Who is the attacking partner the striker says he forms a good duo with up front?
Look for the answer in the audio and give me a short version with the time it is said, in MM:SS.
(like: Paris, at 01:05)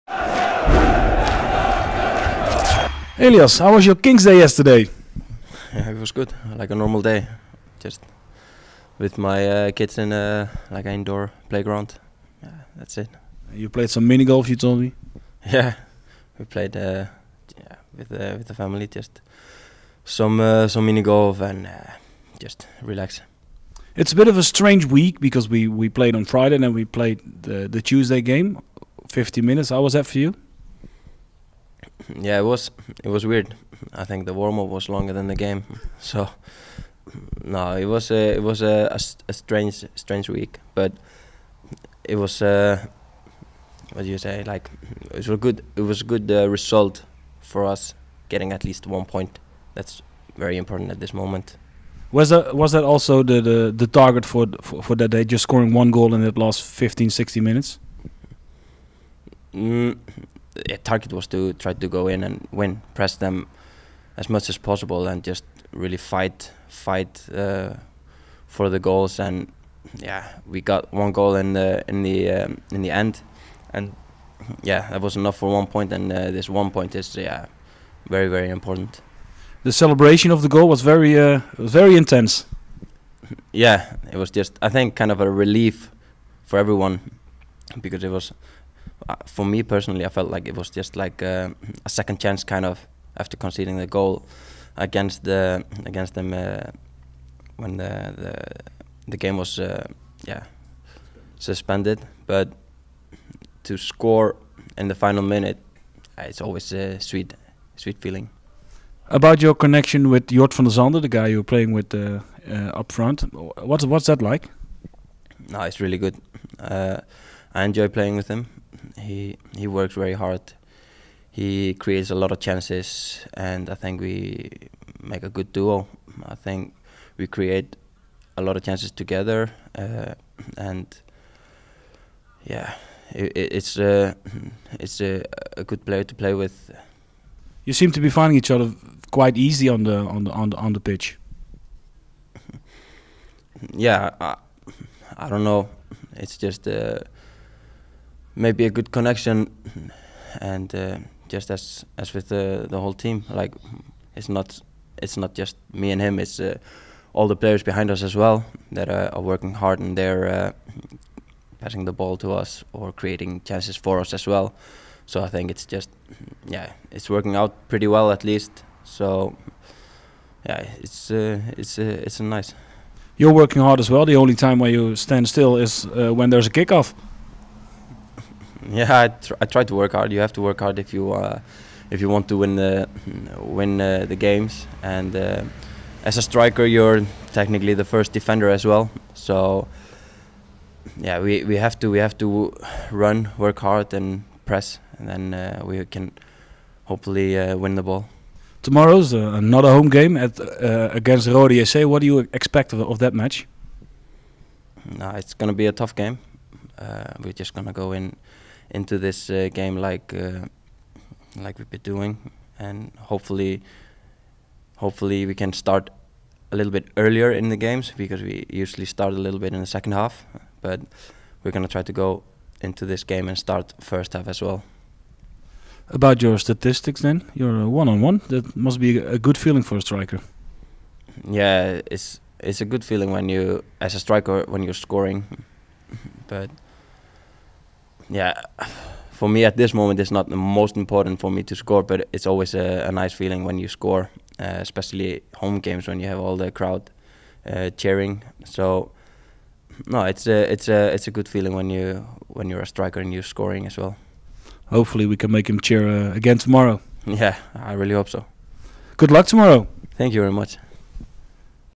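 Jort van der Sande, at 01:50.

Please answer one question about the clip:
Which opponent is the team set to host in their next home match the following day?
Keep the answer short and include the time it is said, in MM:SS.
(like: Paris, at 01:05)
Roda JC, at 03:21.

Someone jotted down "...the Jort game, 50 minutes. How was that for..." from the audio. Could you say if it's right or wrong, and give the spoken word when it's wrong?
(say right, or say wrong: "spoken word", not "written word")
wrong: "Tuesday", not "Jort".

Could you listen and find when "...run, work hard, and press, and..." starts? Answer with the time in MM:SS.
03:12.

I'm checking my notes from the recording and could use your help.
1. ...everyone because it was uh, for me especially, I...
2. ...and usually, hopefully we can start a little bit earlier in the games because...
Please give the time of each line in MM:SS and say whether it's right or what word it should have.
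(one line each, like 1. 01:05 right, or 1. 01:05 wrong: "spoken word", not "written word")
1. 01:26 wrong: "personally", not "especially"
2. 03:32 wrong: "hopefully", not "usually".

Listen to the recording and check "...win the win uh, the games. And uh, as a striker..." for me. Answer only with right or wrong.
right.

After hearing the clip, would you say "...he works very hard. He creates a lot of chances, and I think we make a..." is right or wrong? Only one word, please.
right.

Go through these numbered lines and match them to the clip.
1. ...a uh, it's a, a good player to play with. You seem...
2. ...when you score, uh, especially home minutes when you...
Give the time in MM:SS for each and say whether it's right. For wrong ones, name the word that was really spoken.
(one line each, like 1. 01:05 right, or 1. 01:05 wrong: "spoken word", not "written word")
1. 02:13 right
2. 04:03 wrong: "games", not "minutes".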